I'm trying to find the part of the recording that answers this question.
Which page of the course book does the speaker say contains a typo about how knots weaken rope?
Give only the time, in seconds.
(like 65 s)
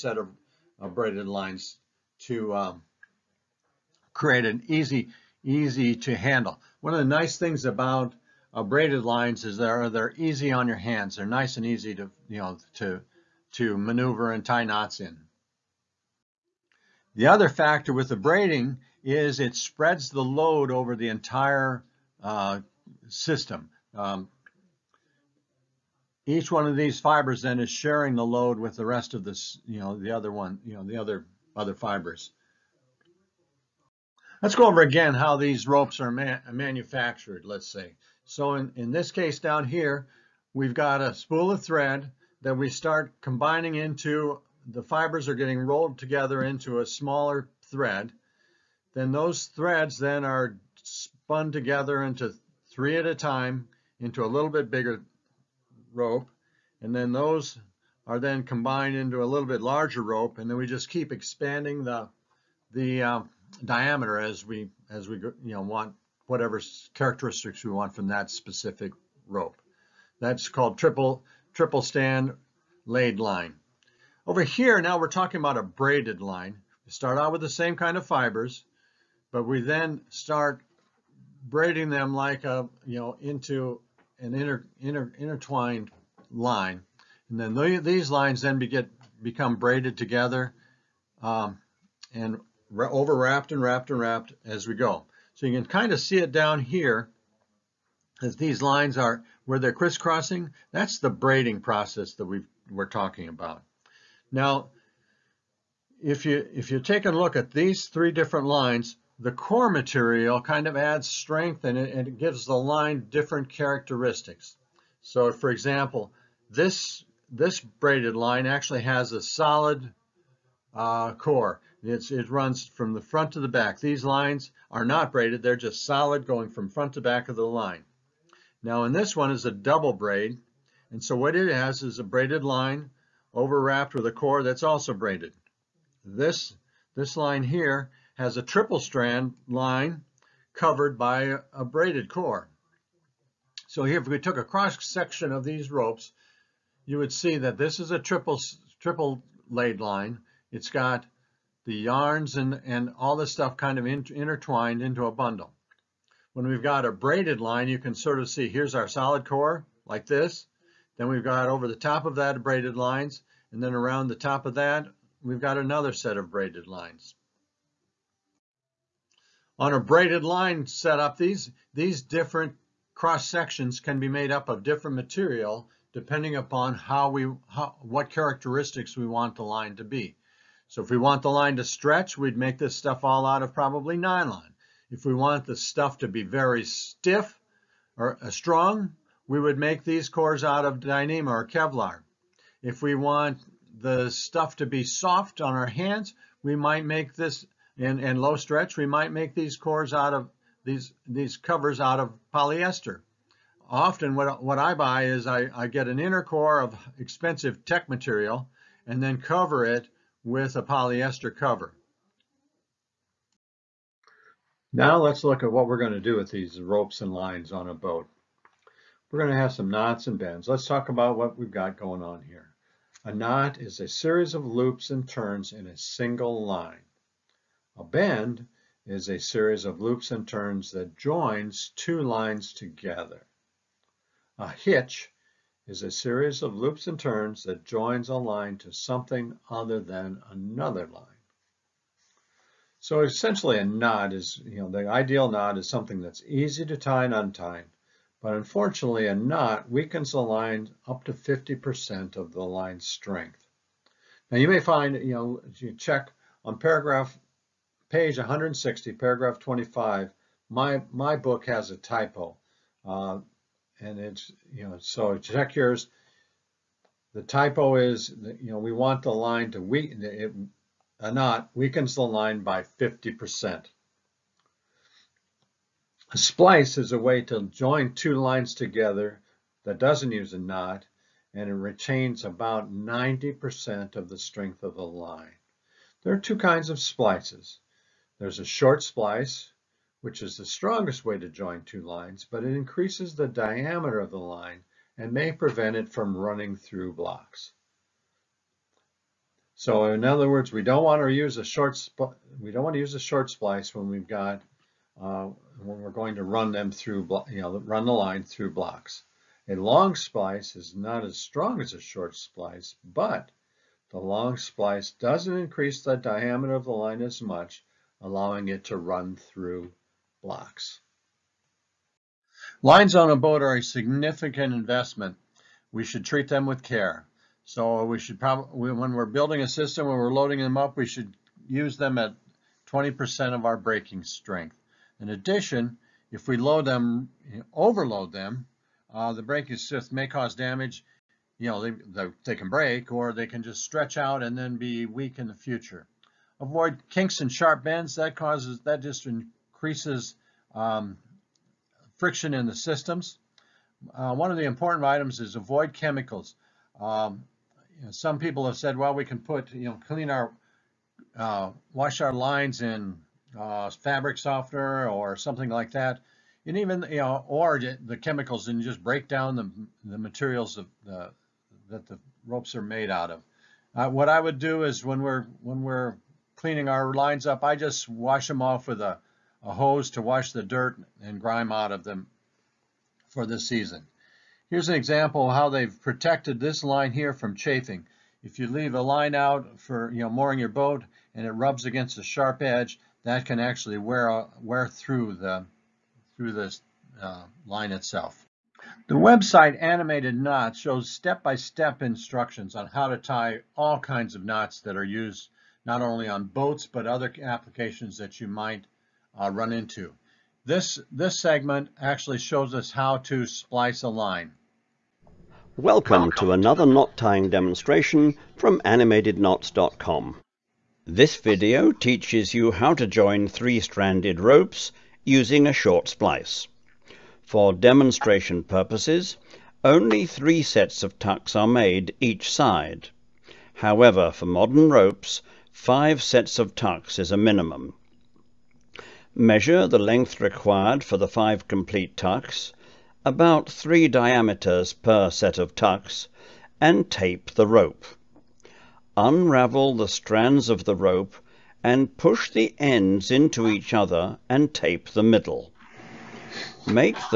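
257 s.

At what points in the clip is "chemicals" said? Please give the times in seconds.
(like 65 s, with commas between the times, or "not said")
355 s, 367 s.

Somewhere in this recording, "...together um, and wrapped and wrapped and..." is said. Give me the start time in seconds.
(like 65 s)
89 s.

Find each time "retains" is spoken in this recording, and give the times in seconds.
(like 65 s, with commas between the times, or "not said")
281 s.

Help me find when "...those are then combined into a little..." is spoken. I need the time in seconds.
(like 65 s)
57 s.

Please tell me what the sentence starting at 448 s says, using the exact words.
Unravel the strands of the rope and push the ends into each other and tape the middle.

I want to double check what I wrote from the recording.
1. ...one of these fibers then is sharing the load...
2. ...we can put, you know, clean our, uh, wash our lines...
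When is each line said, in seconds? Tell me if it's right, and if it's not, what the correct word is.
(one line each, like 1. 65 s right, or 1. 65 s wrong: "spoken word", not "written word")
1. 26 s right
2. 358 s right.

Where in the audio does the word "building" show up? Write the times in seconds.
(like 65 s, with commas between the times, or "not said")
329 s.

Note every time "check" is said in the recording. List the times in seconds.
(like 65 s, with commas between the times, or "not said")
255 s, 265 s.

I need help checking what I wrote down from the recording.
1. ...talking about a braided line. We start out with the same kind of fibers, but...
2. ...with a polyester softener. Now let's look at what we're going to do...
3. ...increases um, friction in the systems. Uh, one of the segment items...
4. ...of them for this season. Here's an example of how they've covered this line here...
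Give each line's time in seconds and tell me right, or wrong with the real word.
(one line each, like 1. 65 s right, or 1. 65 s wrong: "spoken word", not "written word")
1. 75 s right
2. 210 s wrong: "cover", not "softener"
3. 349 s wrong: "important", not "segment"
4. 381 s wrong: "protected", not "covered".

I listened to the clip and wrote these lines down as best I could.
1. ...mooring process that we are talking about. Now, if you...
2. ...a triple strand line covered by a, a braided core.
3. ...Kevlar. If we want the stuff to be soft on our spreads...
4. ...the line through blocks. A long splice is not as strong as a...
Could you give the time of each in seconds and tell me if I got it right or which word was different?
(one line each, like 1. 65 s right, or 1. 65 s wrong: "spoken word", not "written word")
1. 101 s wrong: "braiding", not "mooring"
2. 138 s right
3. 191 s wrong: "hands", not "spreads"
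4. 307 s right.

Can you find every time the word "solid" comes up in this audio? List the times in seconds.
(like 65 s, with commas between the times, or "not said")
119 s, 125 s, 158 s.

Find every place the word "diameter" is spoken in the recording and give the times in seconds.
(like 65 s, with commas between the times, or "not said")
63 s, 293 s, 315 s, 443 s.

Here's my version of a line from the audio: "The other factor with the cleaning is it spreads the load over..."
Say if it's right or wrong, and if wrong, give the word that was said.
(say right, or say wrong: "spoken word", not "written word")
wrong: "braiding", not "cleaning".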